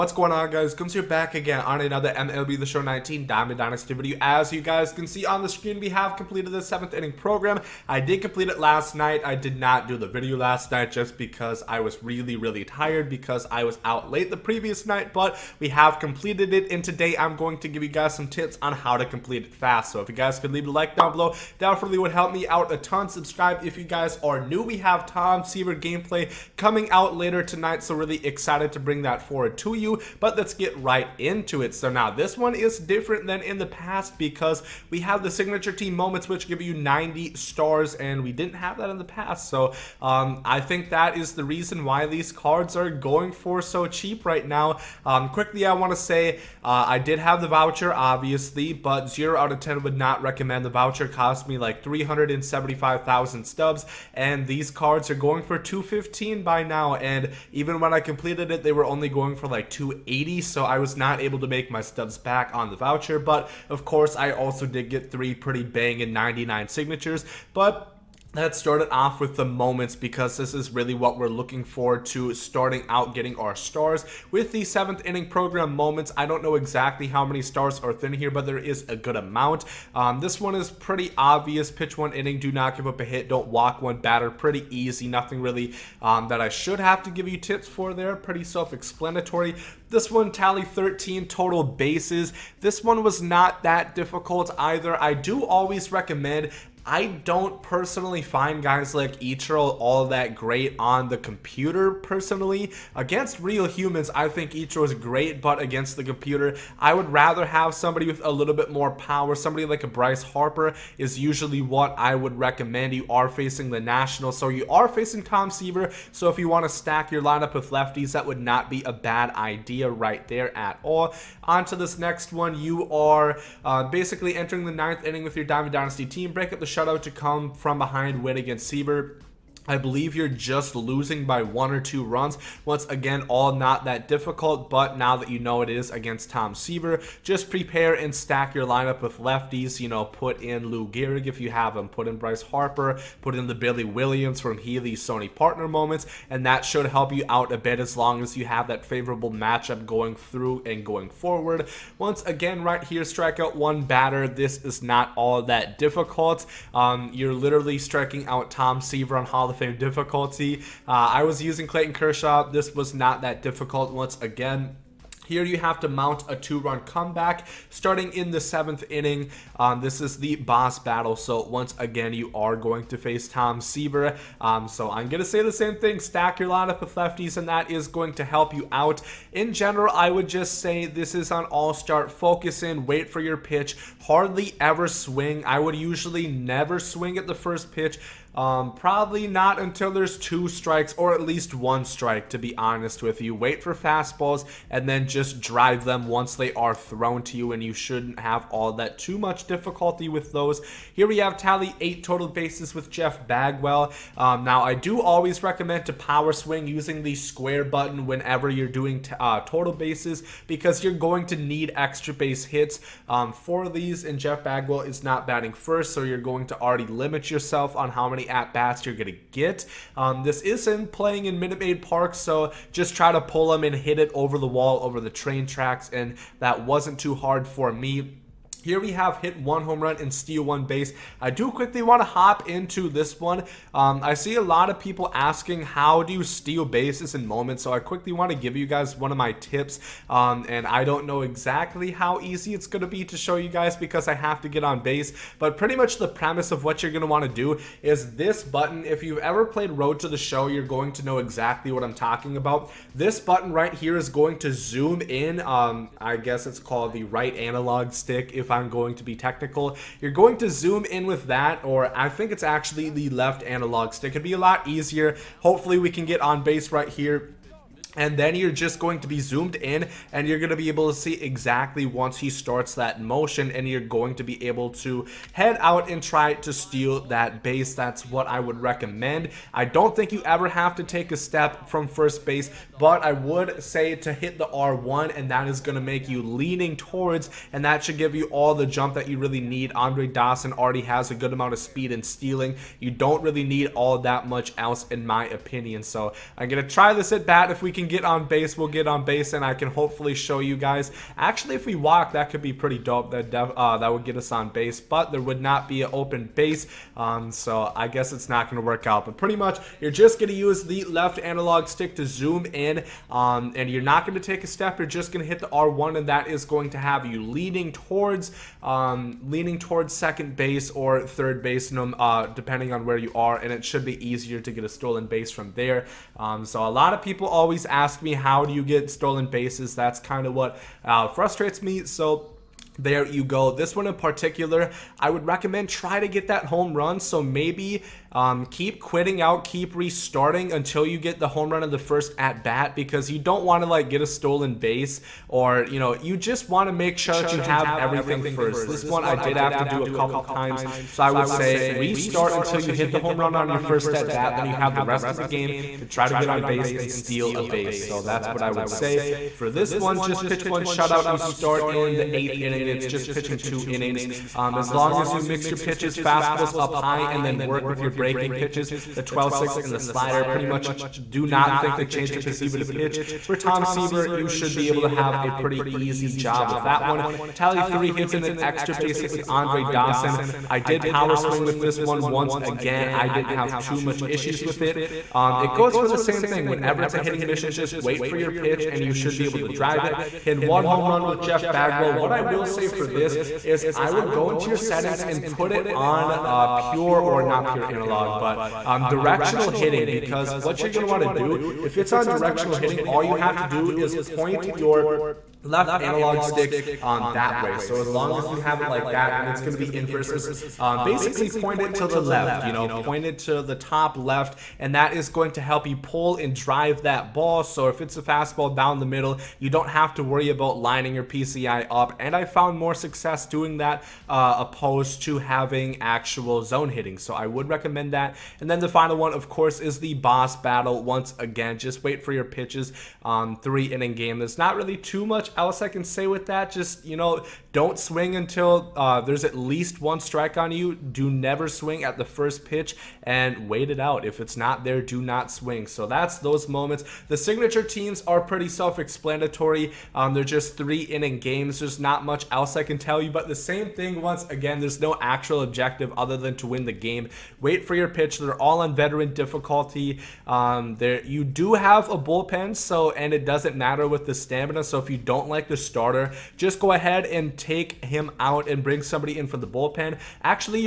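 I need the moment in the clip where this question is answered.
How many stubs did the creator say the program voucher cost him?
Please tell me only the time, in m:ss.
0:51.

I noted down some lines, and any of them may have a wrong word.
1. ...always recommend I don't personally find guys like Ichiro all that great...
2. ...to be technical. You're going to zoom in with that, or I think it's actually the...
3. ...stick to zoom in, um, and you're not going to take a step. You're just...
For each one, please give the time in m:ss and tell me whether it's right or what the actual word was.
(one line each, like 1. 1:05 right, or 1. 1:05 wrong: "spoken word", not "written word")
1. 1:35 right
2. 4:18 right
3. 5:11 right.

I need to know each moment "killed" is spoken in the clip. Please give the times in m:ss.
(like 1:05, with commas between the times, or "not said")
not said.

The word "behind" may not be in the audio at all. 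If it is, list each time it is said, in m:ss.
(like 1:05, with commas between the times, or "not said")
2:07.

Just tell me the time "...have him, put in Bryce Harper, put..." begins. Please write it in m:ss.
2:21.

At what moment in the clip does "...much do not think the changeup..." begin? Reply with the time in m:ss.
6:10.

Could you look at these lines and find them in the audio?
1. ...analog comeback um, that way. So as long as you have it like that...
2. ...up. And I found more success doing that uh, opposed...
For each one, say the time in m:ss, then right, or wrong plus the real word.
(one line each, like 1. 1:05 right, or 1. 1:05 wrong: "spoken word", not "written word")
1. 6:45 wrong: "stick", not "comeback"
2. 7:01 right.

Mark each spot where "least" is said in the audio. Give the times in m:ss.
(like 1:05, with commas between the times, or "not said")
3:11, 7:19.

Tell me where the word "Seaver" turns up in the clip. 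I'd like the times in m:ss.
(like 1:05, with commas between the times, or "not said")
0:25, 1:55, 2:08, 2:16, 2:38, 2:53, 6:13.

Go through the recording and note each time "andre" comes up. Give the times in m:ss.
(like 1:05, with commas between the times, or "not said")
4:49, 6:19.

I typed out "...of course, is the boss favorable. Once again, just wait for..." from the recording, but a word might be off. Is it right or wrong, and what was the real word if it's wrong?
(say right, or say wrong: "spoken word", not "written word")
wrong: "battle", not "favorable".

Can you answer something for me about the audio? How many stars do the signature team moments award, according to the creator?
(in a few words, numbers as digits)
90.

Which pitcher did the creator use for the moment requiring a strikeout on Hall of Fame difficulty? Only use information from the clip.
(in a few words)
Clayton Kershaw.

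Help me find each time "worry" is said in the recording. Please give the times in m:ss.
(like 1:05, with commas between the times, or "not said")
7:00.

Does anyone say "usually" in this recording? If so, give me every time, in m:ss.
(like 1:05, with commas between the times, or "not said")
1:51, 3:05.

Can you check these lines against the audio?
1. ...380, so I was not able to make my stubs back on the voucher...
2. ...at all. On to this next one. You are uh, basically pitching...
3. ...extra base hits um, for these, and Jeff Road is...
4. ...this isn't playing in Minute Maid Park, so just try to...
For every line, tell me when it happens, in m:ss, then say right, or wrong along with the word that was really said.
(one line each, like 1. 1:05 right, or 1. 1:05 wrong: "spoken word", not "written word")
1. 0:59 wrong: "280", not "380"
2. 2:00 wrong: "entering", not "pitching"
3. 3:31 wrong: "Bagwell", not "Road"
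4. 3:40 right.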